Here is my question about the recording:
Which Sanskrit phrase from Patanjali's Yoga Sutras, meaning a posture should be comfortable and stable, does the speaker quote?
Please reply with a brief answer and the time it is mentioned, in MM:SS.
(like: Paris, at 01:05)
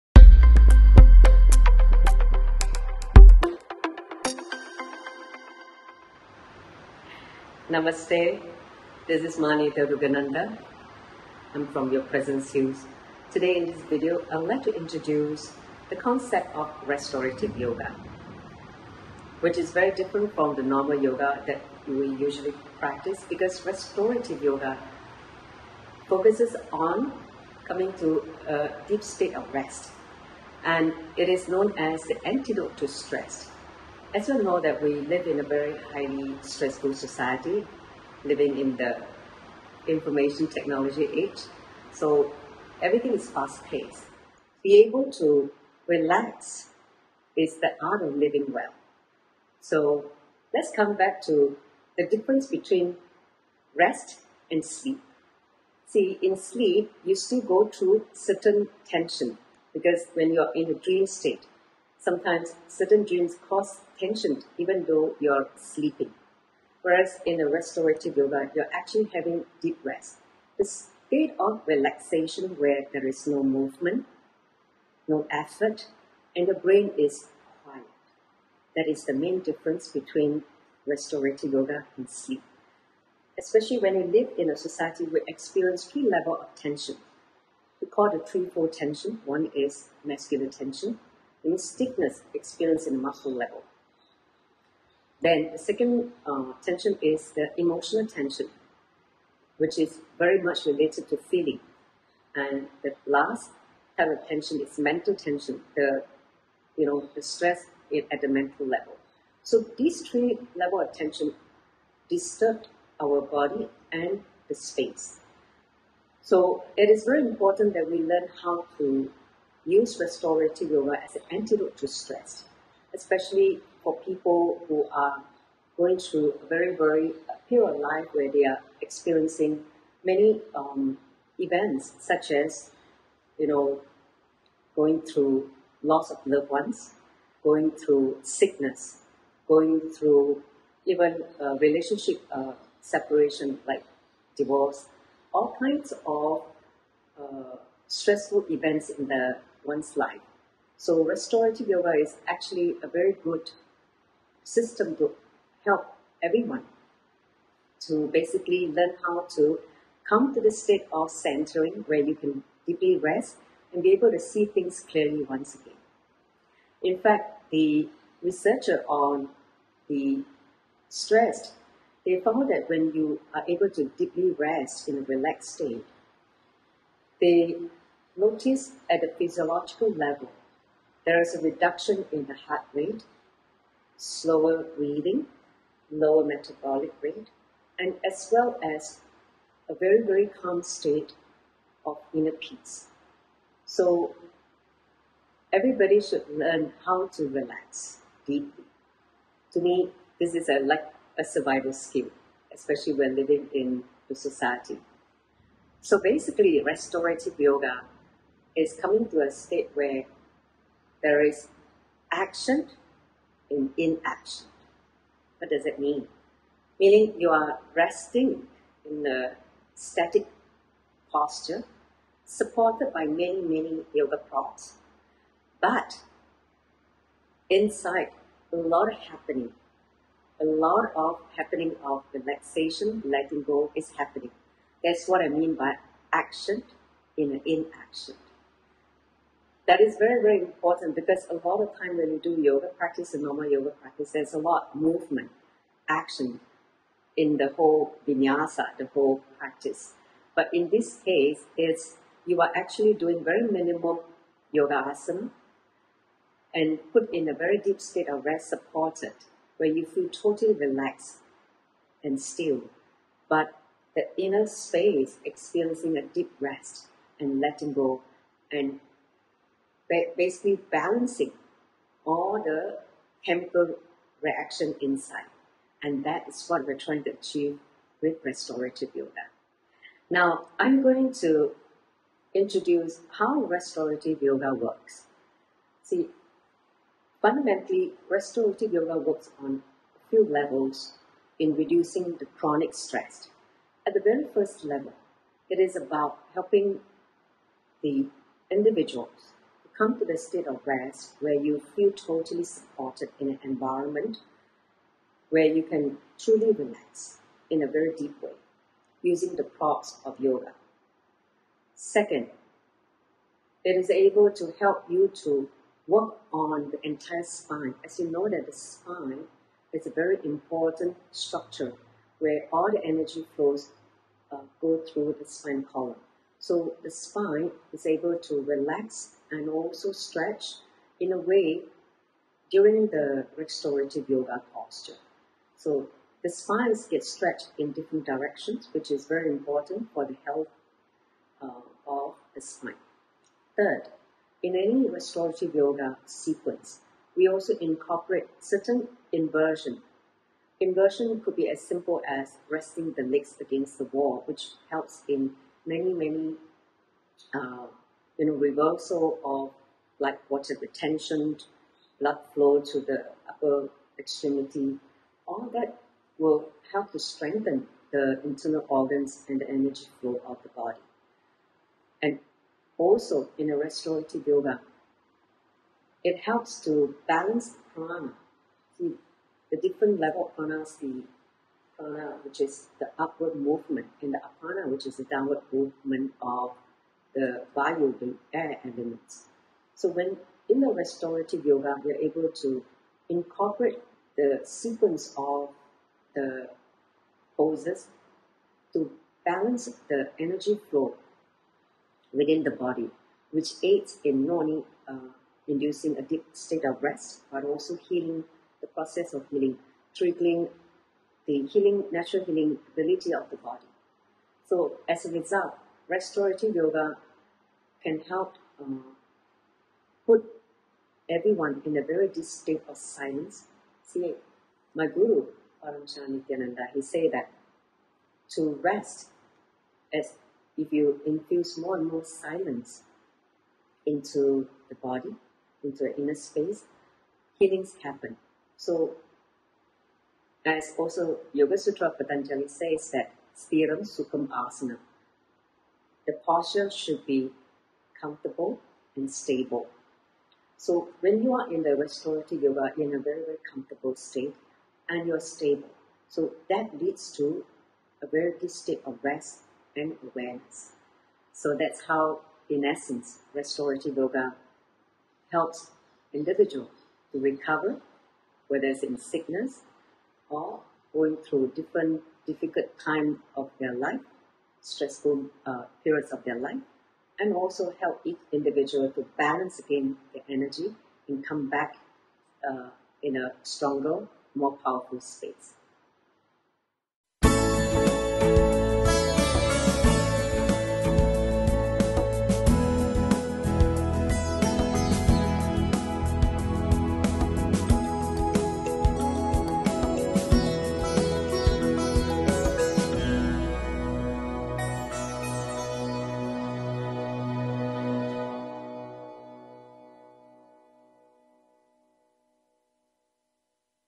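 Sthiram sukham asana, at 07:23.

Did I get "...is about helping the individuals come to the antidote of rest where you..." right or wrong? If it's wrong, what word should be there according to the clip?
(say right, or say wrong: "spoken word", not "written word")
wrong: "state", not "antidote".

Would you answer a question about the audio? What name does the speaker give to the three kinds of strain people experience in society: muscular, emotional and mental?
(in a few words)
threefold tension.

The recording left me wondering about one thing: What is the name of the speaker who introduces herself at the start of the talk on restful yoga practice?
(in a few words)
Ma Nithya Durgananda.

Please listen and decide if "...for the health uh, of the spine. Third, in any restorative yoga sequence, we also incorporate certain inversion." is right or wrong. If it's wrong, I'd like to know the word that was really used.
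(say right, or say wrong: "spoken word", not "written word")
right.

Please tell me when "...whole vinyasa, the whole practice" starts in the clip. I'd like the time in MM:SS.
04:07.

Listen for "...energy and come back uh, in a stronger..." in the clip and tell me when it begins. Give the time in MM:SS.
08:00.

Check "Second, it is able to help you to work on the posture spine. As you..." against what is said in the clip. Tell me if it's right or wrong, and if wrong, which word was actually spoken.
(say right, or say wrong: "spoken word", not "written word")
wrong: "entire", not "posture".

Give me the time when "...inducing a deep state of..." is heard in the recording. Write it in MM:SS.
06:45.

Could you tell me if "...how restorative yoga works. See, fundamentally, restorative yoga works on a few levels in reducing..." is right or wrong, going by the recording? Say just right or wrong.
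right.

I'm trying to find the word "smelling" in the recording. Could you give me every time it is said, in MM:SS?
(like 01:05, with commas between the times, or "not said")
not said.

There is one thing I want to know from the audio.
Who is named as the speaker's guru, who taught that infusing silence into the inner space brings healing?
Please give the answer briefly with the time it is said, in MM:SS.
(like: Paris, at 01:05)
Paramahamsa Nithyananda, at 07:05.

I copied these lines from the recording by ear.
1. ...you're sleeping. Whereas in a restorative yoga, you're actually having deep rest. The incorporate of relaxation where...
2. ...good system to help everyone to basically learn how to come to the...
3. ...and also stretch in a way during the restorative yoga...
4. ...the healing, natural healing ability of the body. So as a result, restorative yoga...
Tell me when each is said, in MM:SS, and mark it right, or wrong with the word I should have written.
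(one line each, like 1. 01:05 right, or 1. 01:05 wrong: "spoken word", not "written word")
1. 01:05 wrong: "state", not "incorporate"
2. 02:33 right
3. 05:29 right
4. 06:51 right.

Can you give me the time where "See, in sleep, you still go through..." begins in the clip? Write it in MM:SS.
00:55.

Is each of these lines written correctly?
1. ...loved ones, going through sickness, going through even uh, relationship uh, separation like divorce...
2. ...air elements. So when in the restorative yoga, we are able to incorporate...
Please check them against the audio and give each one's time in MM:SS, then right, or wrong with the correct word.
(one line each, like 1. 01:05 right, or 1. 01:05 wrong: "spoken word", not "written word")
1. 02:16 right
2. 06:28 right.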